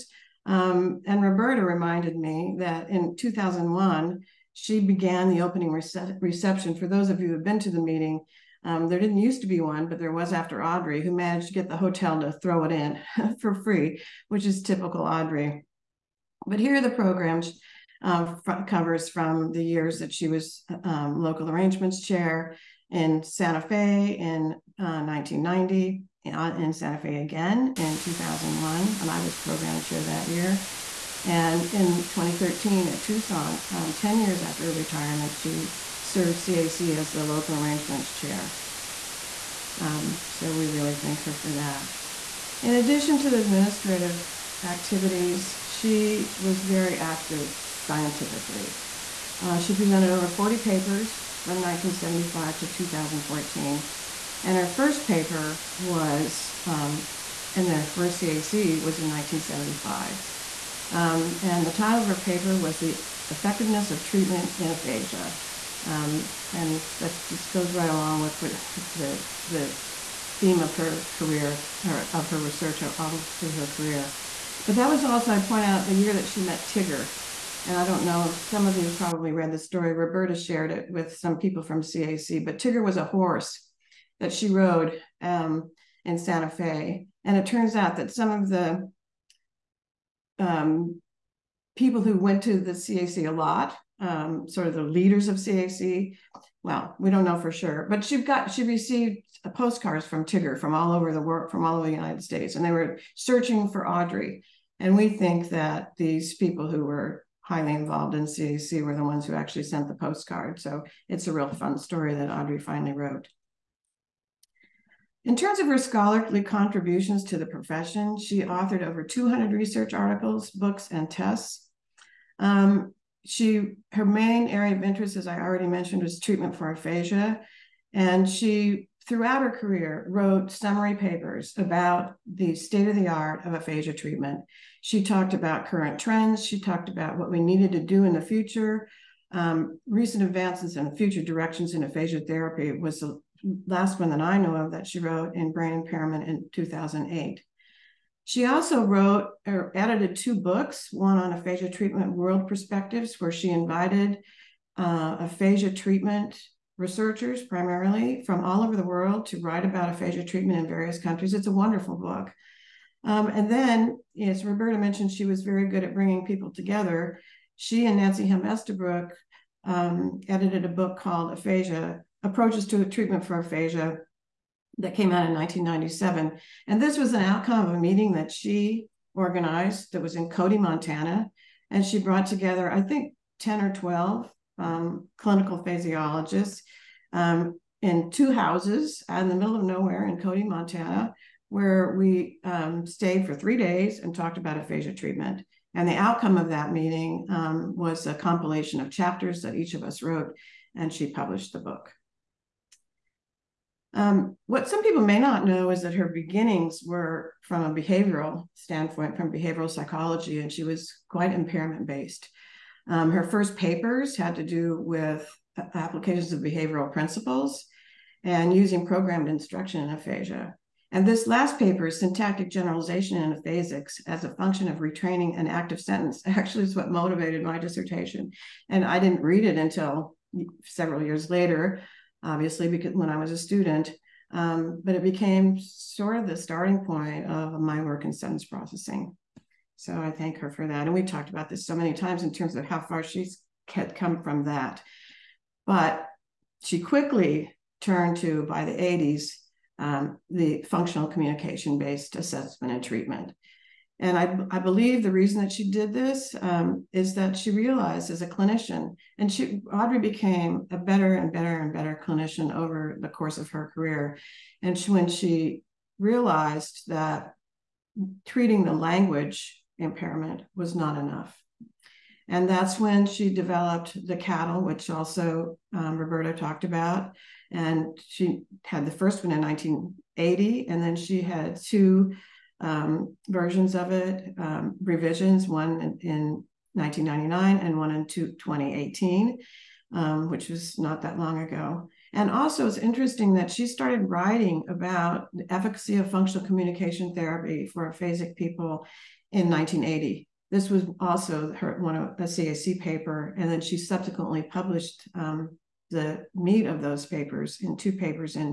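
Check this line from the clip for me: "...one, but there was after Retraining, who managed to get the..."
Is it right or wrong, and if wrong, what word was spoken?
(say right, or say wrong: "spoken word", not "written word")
wrong: "Audrey", not "Retraining".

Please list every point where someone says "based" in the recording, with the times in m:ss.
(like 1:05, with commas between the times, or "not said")
3:31, 4:11.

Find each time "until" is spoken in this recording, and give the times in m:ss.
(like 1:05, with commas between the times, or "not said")
3:49.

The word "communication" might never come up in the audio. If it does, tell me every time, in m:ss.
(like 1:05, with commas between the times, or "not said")
4:11, 4:56.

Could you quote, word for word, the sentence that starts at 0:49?
Uh, she presented over 40 papers from 1975 to 2014.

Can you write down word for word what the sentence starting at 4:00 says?
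And we've talked about this so many times in terms of how far she's had come from that.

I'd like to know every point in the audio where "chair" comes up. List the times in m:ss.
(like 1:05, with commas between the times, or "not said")
0:22, 0:29, 0:38.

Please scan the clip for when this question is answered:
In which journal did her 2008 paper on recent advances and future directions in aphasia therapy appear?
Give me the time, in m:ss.
2:25.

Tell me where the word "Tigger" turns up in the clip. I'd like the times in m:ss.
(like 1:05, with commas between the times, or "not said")
1:16, 1:22, 1:40.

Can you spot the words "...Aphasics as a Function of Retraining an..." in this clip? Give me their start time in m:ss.
3:43.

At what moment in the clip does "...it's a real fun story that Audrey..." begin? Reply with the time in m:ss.
1:51.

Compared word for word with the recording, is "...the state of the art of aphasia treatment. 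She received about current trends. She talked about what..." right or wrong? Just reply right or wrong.
wrong.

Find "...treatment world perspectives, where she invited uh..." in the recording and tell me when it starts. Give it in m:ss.
2:31.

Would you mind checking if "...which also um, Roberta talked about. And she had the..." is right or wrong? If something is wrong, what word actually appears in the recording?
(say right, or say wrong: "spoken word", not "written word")
right.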